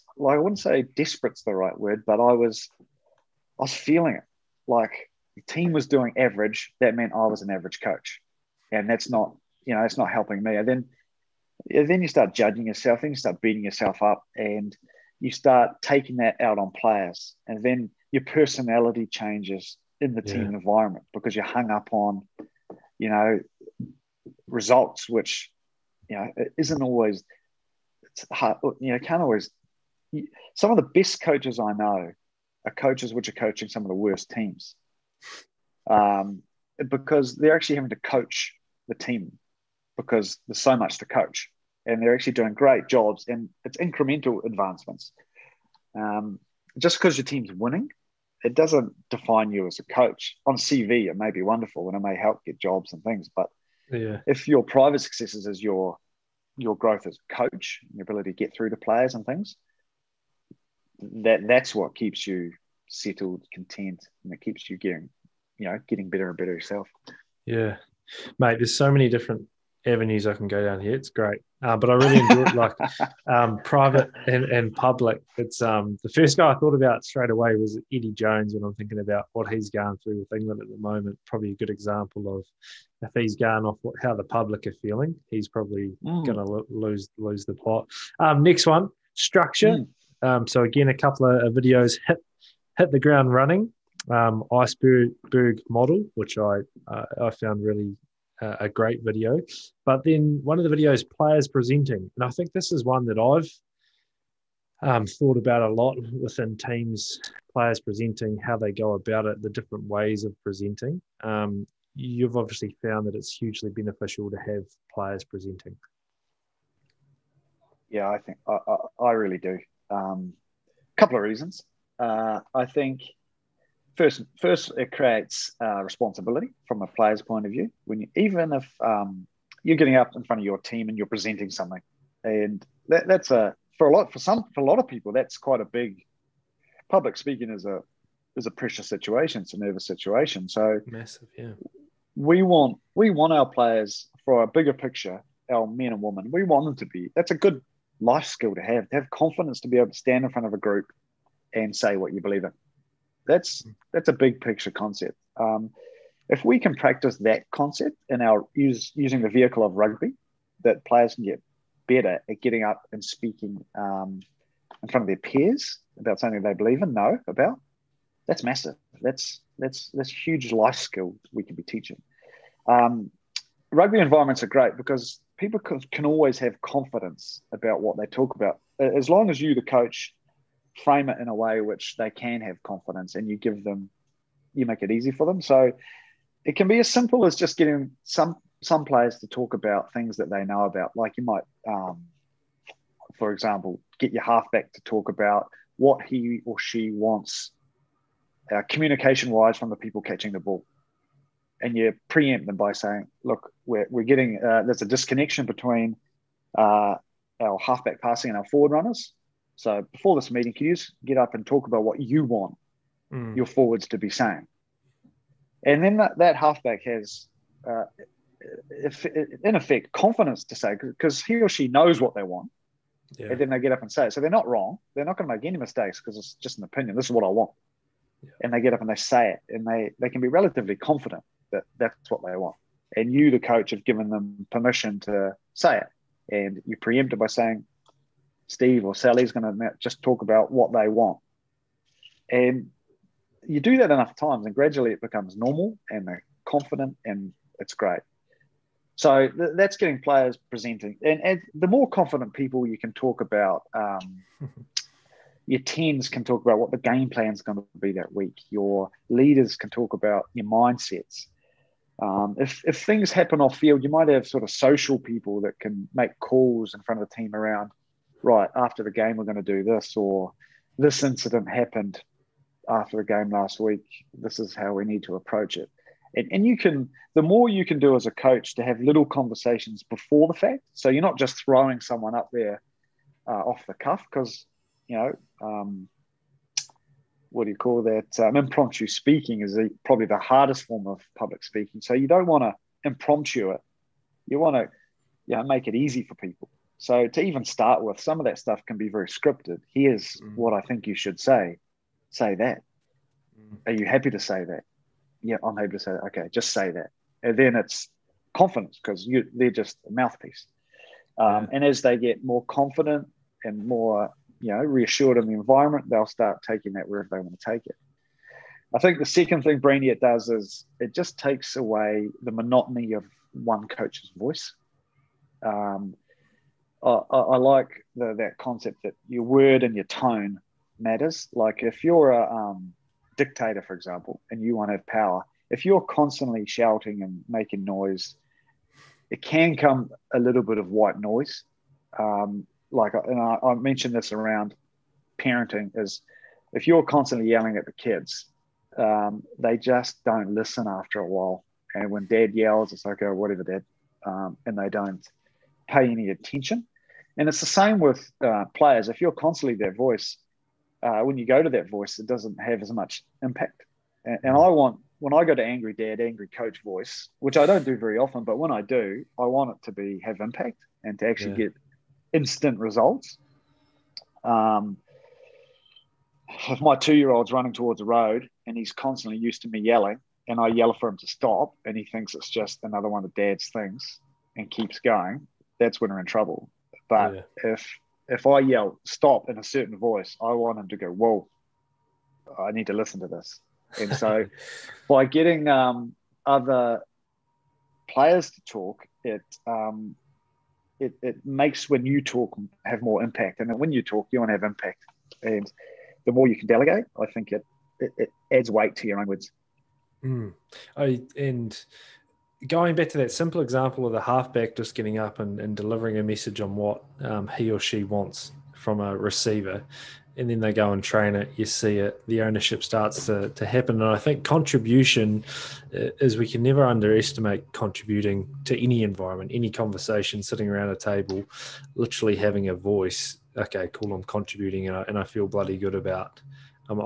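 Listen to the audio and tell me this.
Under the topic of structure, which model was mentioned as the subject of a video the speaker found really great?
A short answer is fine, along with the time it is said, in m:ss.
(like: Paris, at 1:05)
Iceberg model, at 1:34.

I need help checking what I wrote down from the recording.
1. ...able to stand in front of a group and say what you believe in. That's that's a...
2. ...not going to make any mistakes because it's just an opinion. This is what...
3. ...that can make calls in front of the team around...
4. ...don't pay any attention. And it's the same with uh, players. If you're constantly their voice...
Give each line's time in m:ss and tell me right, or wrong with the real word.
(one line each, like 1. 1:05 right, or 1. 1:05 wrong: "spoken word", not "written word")
1. 2:29 right
2. 3:45 right
3. 4:25 right
4. 5:54 right.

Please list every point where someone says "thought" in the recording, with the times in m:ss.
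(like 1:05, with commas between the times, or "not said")
1:16, 1:45.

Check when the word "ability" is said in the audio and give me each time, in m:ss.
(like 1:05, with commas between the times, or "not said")
0:58.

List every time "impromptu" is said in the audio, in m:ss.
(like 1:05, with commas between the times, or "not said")
4:48, 4:52.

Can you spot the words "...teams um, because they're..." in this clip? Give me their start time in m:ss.
0:34.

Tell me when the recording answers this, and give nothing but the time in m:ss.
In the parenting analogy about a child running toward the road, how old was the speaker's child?
6:16.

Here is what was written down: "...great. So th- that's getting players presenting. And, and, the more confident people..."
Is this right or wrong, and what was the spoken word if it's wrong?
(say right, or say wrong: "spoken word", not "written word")
right.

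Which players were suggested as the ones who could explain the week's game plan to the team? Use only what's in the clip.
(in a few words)
Your tens.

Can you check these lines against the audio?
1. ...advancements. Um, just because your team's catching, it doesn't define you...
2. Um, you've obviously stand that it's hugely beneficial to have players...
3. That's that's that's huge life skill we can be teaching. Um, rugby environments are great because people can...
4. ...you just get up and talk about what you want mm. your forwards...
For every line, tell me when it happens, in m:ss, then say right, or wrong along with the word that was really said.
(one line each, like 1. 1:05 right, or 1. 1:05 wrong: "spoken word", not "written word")
1. 0:44 wrong: "winning", not "catching"
2. 1:51 wrong: "found", not "stand"
3. 2:49 right
4. 3:30 right.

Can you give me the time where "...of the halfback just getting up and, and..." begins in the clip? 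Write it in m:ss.
6:53.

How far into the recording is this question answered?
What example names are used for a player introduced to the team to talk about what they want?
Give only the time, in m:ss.
3:58.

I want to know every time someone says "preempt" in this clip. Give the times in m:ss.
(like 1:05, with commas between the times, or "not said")
3:22, 3:56.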